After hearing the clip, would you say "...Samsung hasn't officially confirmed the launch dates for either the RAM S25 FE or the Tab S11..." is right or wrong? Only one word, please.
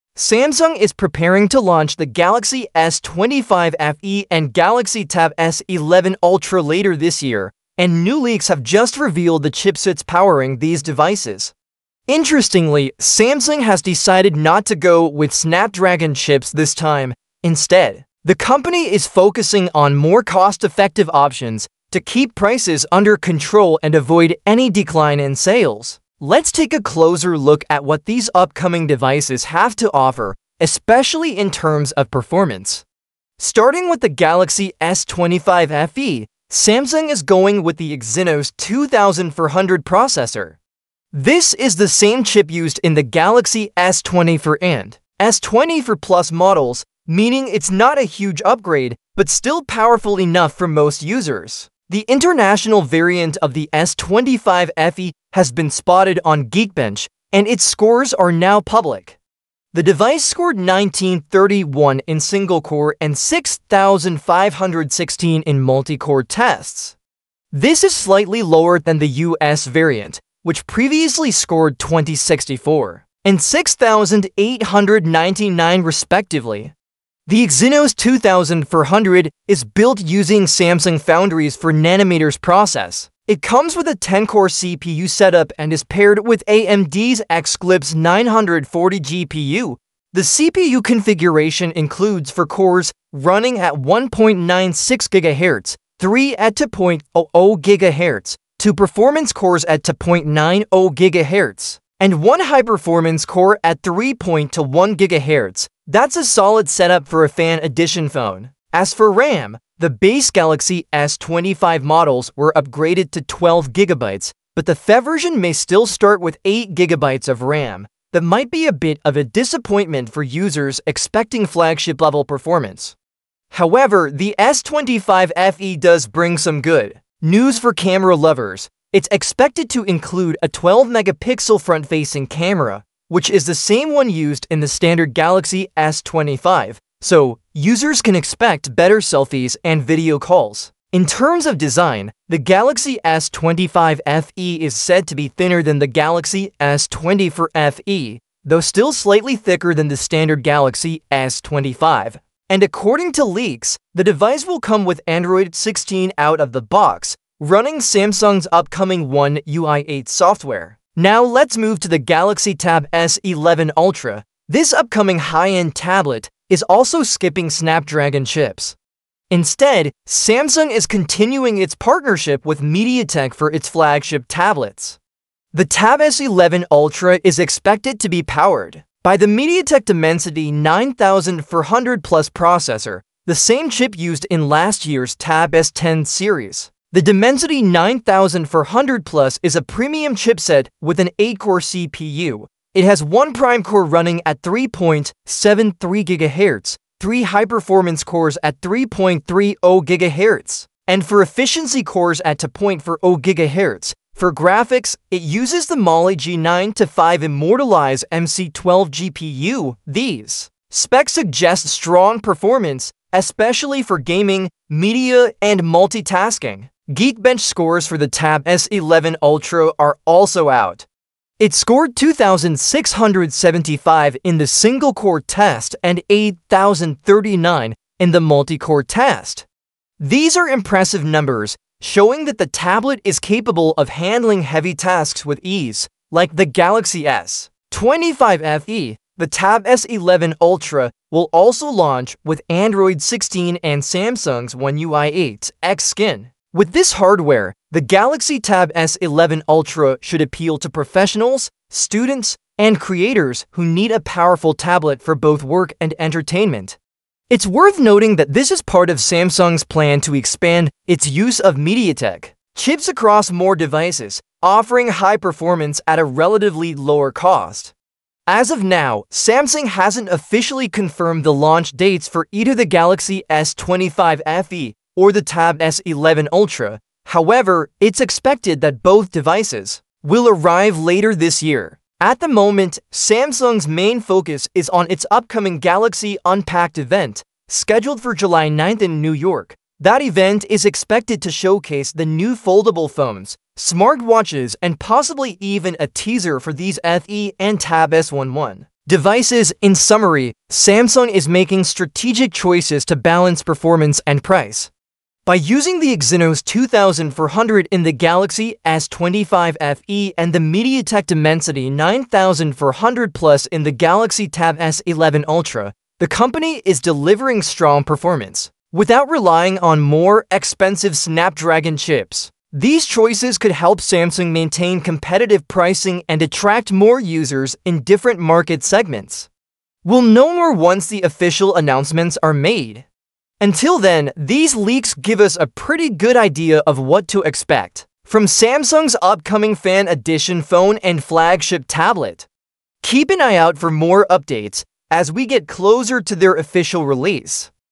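wrong.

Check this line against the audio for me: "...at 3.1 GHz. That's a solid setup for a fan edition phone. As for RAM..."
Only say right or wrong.
right.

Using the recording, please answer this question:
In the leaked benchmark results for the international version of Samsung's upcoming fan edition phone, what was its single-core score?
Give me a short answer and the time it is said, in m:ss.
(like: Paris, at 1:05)
1931, at 1:00.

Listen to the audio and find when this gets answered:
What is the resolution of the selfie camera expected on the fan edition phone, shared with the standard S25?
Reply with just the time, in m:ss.
2:10.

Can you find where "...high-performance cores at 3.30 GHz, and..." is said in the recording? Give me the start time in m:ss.
3:17.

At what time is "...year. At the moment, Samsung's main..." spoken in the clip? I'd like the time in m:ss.
4:41.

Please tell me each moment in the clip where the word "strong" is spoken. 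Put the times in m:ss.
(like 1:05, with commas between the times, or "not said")
3:31, 5:17.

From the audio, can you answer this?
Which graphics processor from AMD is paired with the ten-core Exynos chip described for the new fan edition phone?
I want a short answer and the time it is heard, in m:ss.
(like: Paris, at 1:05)
Xclipse 940, at 1:27.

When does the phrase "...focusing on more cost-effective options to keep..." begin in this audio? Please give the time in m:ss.
0:19.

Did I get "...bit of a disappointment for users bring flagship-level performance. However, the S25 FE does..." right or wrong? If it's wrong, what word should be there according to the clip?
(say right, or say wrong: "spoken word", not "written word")
wrong: "expecting", not "bring".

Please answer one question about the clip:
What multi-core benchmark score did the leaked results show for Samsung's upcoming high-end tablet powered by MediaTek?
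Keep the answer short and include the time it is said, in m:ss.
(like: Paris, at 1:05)
8,039, at 3:46.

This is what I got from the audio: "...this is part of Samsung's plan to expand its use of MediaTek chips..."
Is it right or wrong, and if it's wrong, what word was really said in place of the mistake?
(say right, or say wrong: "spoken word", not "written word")
right.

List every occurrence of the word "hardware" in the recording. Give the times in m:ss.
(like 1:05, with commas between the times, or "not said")
4:06.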